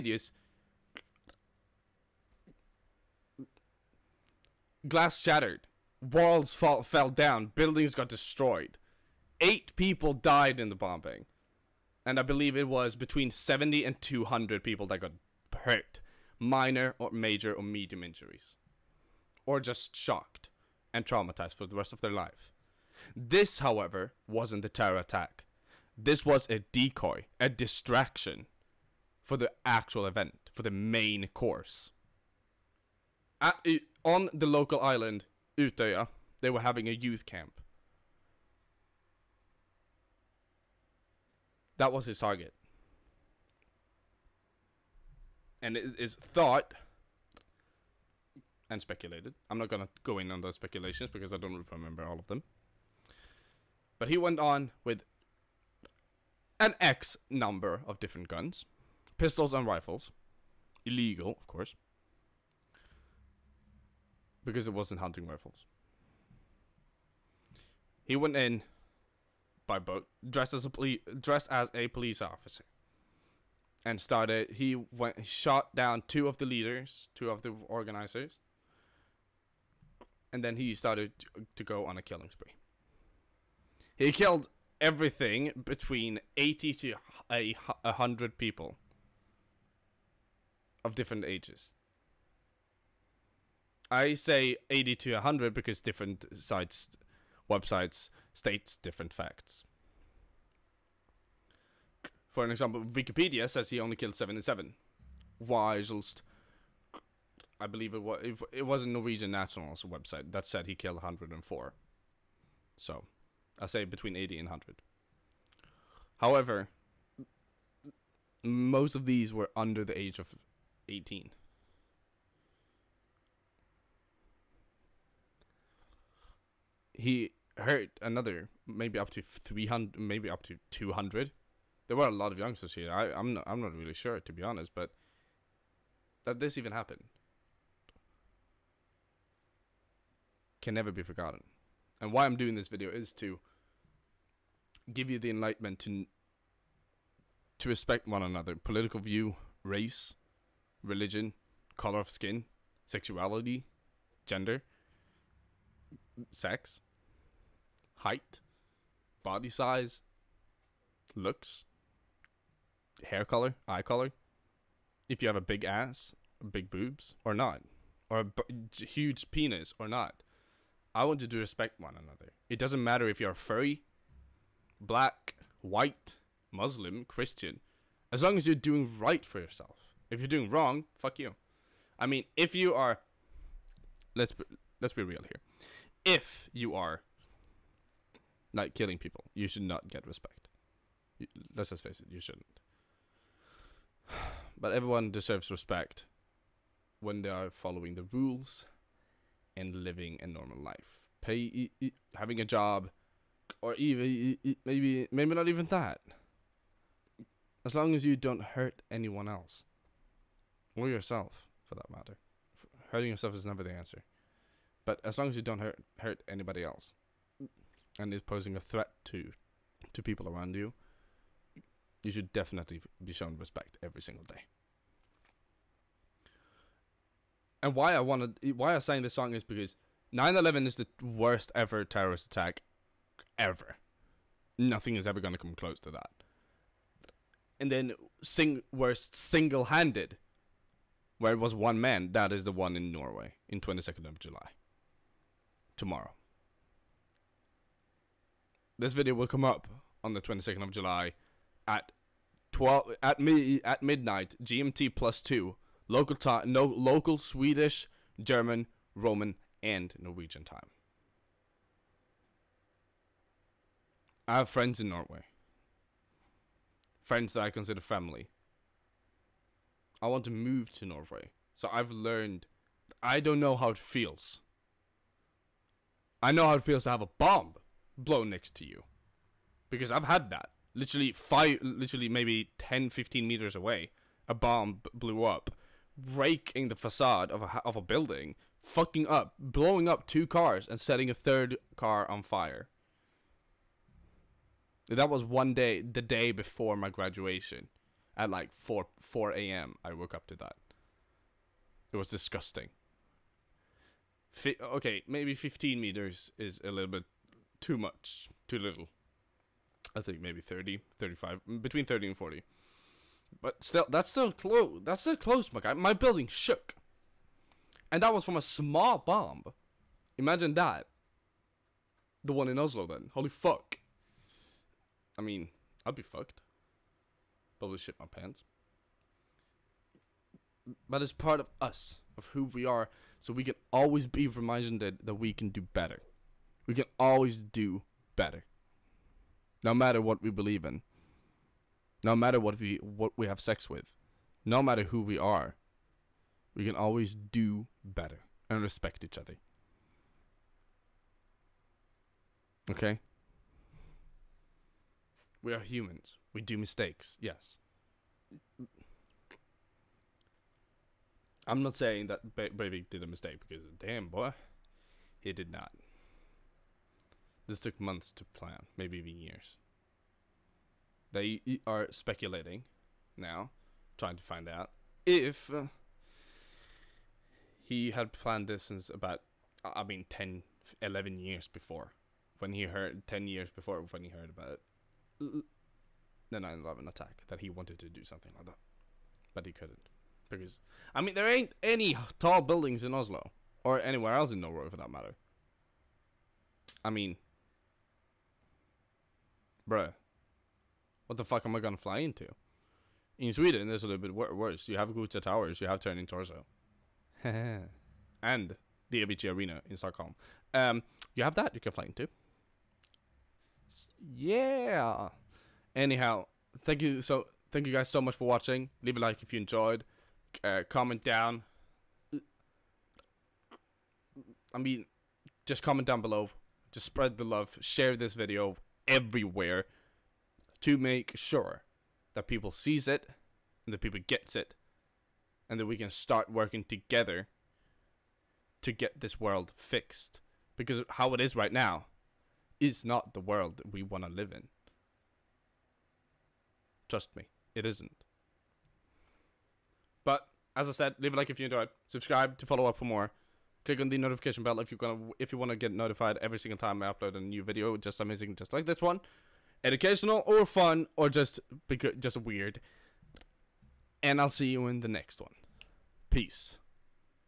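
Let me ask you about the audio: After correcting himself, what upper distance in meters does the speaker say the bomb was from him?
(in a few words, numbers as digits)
40 meters.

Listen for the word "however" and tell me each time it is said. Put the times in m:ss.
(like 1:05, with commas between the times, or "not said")
0:23, 1:56.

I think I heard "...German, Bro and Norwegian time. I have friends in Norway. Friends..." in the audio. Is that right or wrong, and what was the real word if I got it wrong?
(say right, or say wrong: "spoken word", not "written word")
wrong: "Roman", not "Bro".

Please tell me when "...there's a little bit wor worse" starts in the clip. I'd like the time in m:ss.
6:43.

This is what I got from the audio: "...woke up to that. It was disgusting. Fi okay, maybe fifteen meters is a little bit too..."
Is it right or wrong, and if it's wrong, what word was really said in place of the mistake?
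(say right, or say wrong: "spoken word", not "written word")
right.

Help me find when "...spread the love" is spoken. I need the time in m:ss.
7:06.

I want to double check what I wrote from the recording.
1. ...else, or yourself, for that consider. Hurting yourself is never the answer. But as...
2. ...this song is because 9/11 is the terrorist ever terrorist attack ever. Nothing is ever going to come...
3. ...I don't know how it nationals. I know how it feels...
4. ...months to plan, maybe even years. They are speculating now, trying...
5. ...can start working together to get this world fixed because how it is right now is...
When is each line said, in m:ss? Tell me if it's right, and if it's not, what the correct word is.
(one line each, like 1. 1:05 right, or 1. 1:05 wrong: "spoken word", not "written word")
1. 3:29 wrong: "matter", not "consider"
2. 3:49 wrong: "worst", not "terrorist"
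3. 4:33 wrong: "feels", not "nationals"
4. 6:07 right
5. 7:15 right.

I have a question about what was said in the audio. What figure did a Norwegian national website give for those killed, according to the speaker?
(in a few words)
104.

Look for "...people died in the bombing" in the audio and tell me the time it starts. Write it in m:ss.
0:09.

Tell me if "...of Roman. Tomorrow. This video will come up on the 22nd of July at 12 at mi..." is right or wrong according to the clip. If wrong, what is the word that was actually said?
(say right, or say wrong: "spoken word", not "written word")
wrong: "July", not "Roman".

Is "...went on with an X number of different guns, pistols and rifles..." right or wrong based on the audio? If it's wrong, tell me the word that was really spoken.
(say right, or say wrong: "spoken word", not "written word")
right.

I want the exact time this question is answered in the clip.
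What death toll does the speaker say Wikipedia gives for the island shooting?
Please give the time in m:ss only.
1:44.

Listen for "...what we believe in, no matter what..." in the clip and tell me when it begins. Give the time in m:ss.
5:40.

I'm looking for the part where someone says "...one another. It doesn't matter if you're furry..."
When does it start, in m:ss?
2:51.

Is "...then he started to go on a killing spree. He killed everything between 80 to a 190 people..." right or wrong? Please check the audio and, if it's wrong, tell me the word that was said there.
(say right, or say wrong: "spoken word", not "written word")
wrong: "100", not "190".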